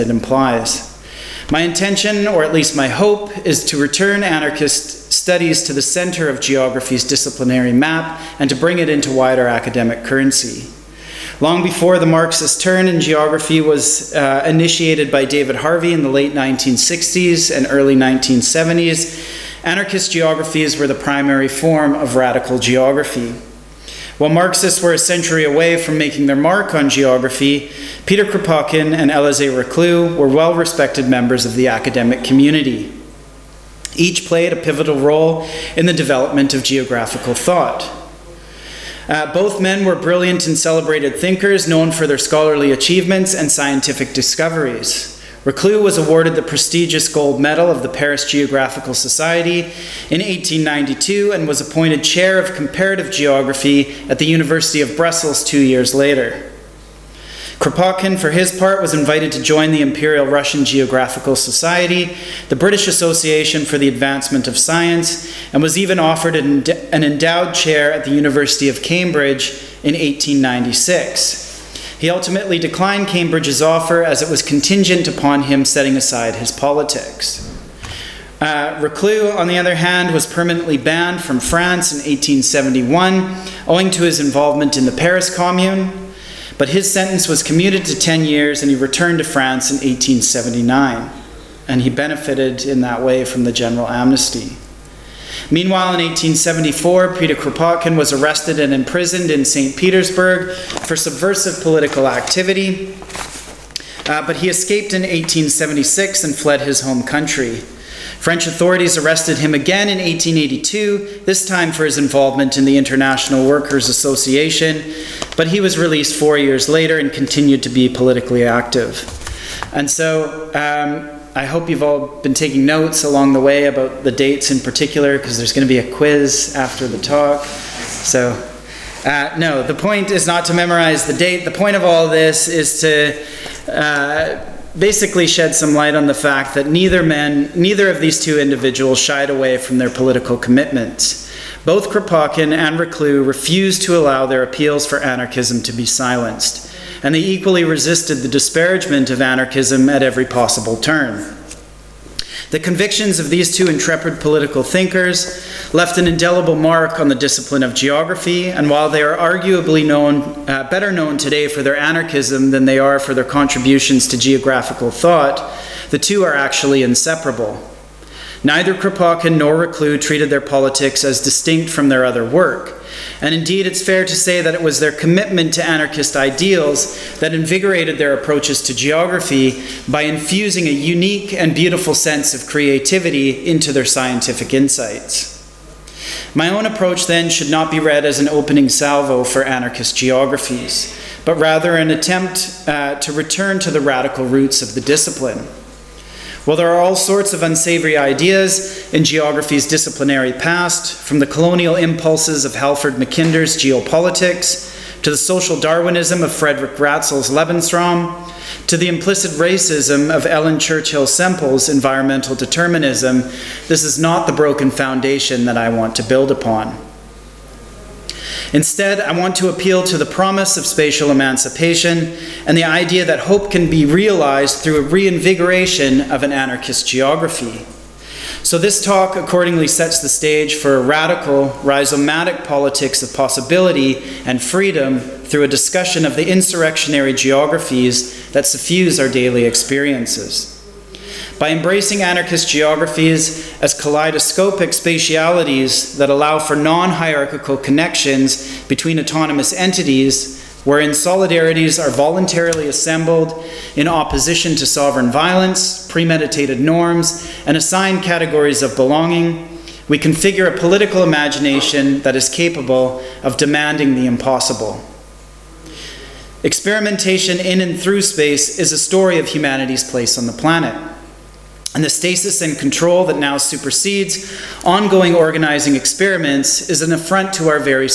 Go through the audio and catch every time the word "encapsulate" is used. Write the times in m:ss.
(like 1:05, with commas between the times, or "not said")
not said.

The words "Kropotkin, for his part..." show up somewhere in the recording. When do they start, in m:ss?
0:57.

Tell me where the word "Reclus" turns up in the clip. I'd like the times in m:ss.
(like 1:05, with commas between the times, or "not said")
0:29, 0:45, 1:18, 2:22, 2:49.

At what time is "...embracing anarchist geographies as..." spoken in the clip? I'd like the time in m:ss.
4:01.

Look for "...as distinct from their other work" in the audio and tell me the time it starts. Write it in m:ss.
2:51.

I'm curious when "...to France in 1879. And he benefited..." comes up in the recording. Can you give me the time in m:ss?
1:29.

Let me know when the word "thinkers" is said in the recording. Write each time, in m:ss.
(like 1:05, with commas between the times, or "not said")
0:41, 2:34.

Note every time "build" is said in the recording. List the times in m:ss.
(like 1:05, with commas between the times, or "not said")
3:36.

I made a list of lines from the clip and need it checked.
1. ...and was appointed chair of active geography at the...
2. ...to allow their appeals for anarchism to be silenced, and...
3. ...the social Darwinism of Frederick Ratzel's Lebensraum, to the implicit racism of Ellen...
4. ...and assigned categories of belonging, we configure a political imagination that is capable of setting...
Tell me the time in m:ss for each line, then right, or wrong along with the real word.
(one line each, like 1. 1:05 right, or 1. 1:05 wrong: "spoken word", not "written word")
1. 0:51 wrong: "comparative", not "active"
2. 2:23 right
3. 3:25 right
4. 4:17 wrong: "demanding", not "setting".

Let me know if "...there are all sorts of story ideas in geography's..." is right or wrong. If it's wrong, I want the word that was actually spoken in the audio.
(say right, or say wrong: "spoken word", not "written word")
wrong: "unsavory", not "story".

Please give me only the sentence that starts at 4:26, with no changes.
Experimentation in and through space is a story of humanity's place on the planet.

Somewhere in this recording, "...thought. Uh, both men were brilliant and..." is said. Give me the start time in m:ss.
0:37.